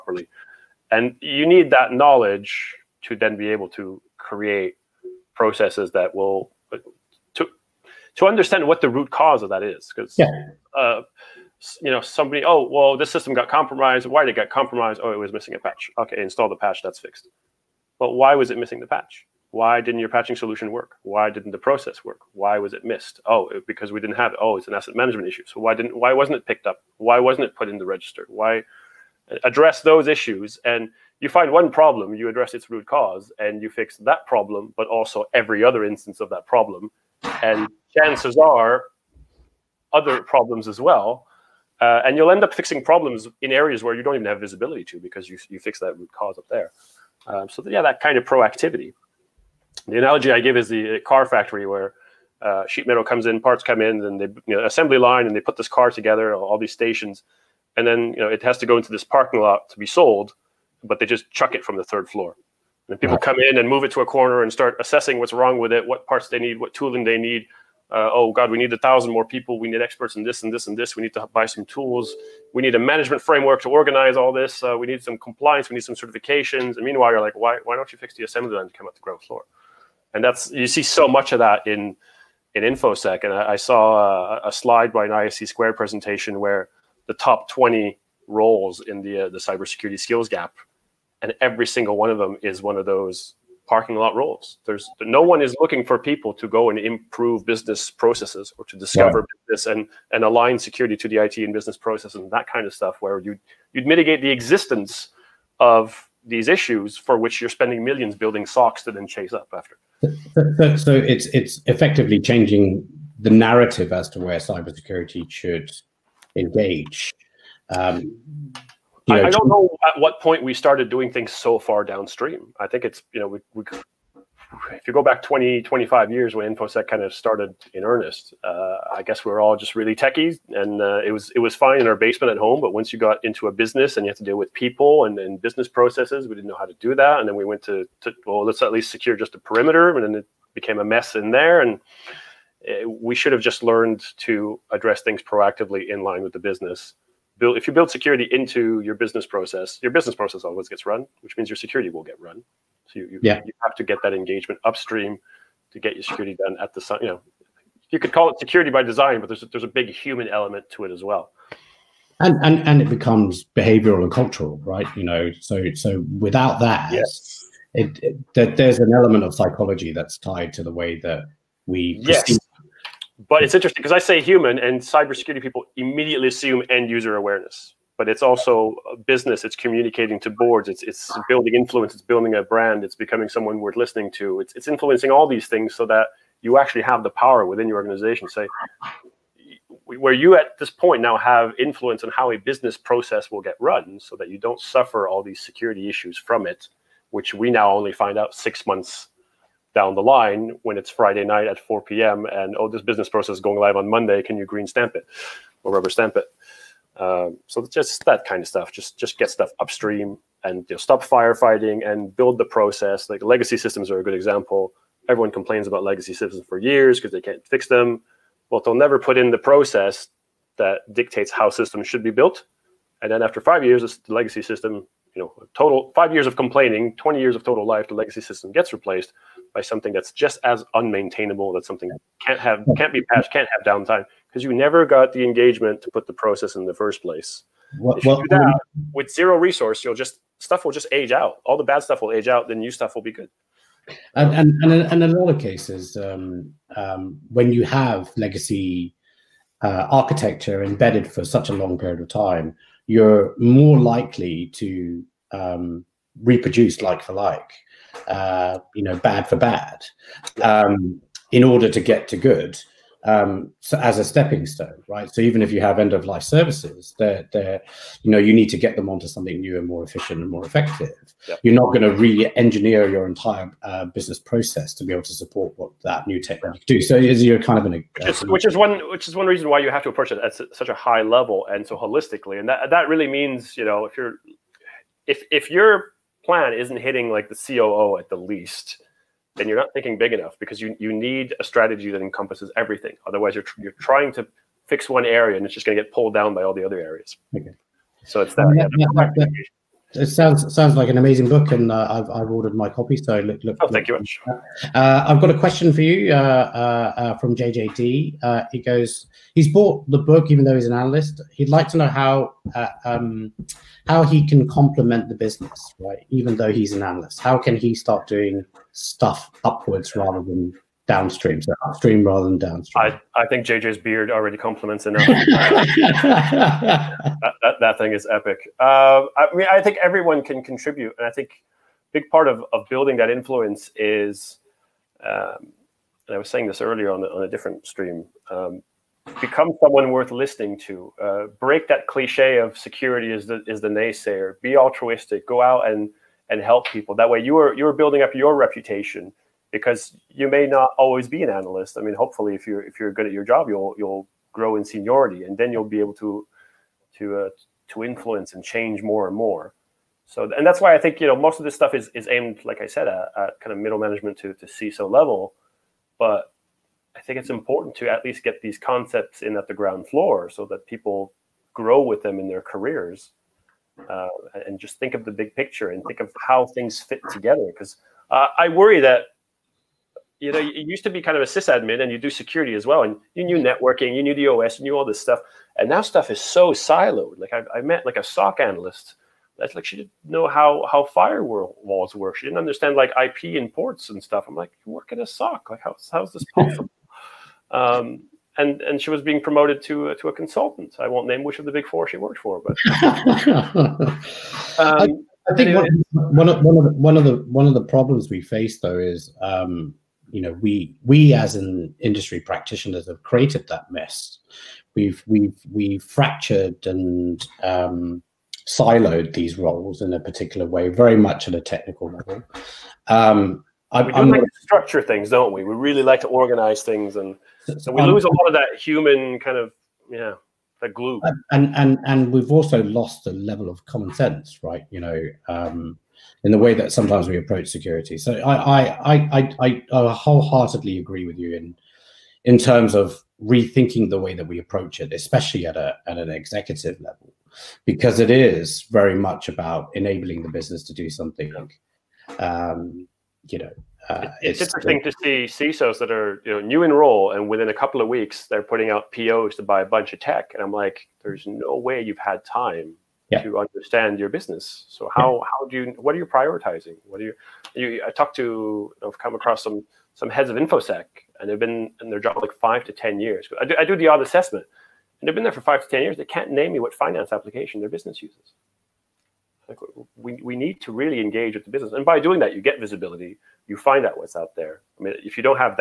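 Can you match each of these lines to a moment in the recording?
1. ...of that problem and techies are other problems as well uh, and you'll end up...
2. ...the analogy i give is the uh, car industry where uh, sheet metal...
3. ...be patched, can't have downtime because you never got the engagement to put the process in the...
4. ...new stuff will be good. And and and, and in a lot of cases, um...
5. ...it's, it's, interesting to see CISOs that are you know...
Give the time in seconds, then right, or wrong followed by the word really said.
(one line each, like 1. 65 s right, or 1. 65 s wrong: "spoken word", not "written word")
1. 36 s wrong: "chances", not "techies"
2. 49 s wrong: "factory", not "industry"
3. 232 s right
4. 242 s right
5. 454 s right.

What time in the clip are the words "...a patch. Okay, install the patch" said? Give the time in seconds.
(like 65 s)
15 s.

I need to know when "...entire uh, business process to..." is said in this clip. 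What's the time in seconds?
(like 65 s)
273 s.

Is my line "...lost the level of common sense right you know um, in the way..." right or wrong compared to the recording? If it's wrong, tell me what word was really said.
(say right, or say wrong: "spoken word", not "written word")
right.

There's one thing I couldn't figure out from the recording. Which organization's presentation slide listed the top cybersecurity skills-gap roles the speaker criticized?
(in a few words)
ISC Square.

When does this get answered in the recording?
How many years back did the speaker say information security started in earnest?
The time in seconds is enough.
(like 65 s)
125 s.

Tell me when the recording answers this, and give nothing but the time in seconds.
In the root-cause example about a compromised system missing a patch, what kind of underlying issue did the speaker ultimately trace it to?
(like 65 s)
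24 s.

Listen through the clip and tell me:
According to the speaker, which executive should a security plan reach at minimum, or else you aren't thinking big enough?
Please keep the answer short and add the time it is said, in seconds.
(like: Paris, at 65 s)
COO, at 287 s.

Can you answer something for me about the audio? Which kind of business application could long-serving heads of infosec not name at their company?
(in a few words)
finance application.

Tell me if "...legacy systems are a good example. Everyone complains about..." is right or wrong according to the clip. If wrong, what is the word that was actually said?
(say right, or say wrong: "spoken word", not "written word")
right.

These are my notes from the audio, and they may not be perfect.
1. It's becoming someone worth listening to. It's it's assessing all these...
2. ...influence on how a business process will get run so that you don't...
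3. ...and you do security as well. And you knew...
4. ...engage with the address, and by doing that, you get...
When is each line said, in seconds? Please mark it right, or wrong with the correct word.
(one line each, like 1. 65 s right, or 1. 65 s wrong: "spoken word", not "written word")
1. 182 s wrong: "influencing", not "assessing"
2. 191 s right
3. 381 s right
4. 481 s wrong: "business", not "address".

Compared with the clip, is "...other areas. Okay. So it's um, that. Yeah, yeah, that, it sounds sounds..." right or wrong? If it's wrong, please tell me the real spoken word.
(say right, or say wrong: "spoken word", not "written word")
right.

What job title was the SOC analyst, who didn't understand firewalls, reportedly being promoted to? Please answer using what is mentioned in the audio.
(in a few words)
consultant.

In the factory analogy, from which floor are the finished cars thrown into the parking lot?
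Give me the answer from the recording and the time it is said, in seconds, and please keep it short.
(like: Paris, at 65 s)
third floor, at 61 s.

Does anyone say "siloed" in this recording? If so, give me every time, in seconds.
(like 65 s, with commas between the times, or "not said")
386 s, 418 s.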